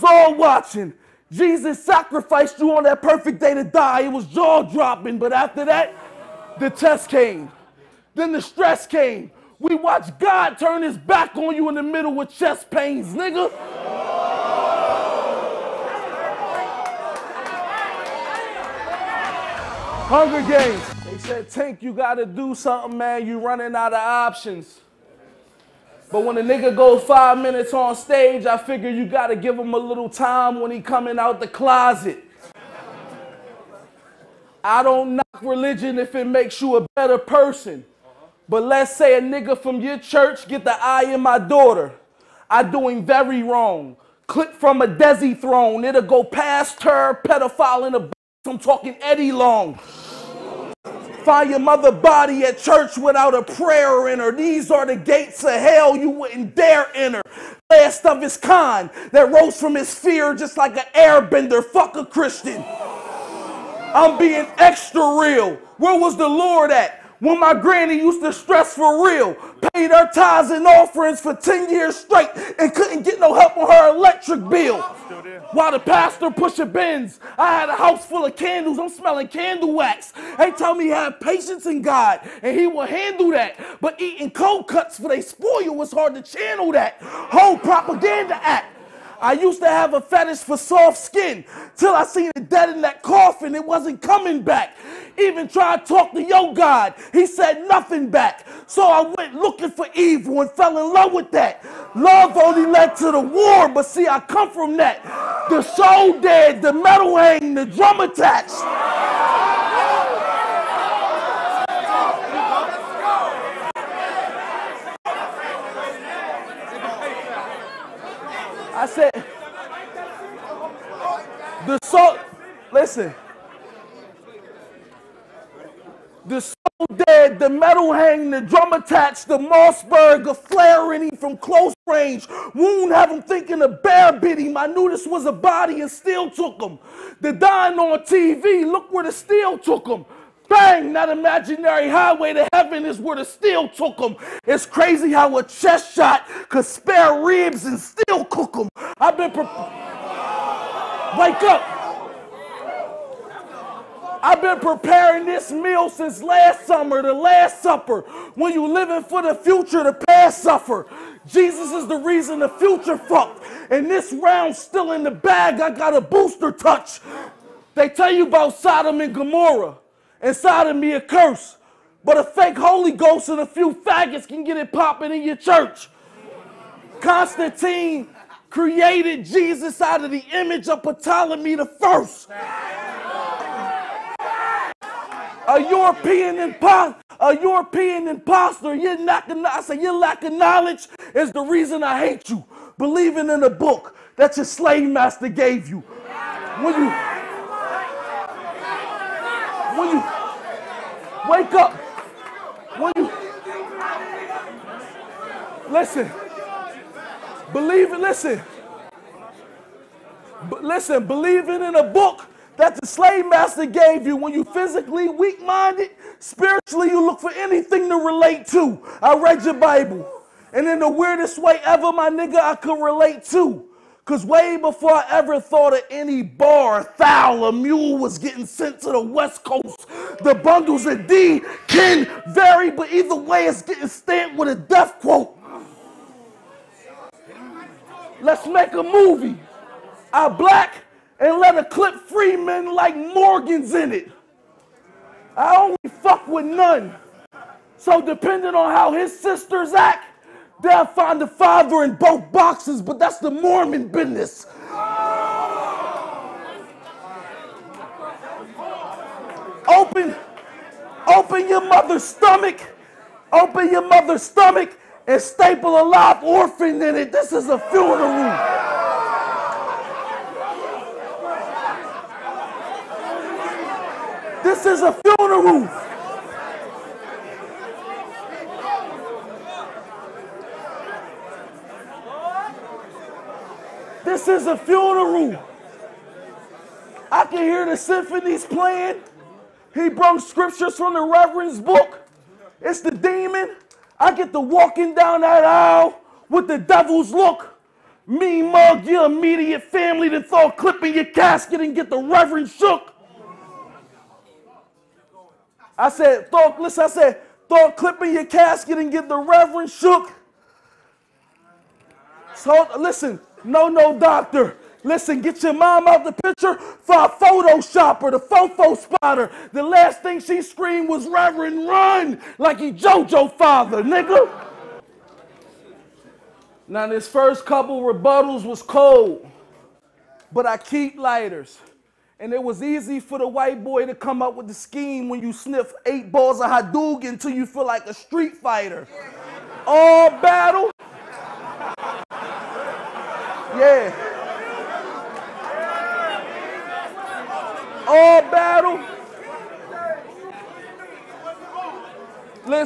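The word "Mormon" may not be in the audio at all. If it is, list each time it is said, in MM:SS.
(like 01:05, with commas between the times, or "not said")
04:13.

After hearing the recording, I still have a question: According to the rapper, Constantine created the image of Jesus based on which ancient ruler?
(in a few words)
Ptolemy the First.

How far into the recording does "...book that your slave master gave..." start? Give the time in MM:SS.
03:13.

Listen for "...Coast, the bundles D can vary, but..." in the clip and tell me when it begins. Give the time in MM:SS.
03:49.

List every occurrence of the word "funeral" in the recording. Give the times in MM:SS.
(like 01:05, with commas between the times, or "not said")
04:27, 04:34, 04:44.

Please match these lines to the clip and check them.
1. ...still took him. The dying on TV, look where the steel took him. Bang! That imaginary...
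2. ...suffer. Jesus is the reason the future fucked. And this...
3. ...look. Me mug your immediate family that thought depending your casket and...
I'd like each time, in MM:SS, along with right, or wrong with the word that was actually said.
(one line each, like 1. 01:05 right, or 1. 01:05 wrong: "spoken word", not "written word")
1. 02:15 right
2. 02:40 right
3. 04:57 wrong: "clipping", not "depending".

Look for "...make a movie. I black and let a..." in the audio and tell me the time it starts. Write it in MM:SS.
03:58.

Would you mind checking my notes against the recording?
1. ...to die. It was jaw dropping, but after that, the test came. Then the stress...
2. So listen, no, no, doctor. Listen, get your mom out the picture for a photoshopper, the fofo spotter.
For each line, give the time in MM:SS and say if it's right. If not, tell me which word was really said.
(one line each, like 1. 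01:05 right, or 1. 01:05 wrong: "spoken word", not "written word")
1. 00:03 right
2. 05:12 right.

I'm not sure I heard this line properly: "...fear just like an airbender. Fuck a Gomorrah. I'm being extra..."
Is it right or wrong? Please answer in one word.
wrong.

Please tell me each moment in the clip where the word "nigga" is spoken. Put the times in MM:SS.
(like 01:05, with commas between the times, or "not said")
00:13, 00:26, 00:39, 03:42, 05:23.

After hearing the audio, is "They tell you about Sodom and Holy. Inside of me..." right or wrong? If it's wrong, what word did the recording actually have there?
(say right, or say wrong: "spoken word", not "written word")
wrong: "Gomorrah", not "Holy".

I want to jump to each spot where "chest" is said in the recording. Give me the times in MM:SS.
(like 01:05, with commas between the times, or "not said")
00:12, 02:25.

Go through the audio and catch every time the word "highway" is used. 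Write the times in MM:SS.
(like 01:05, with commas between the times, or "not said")
02:21.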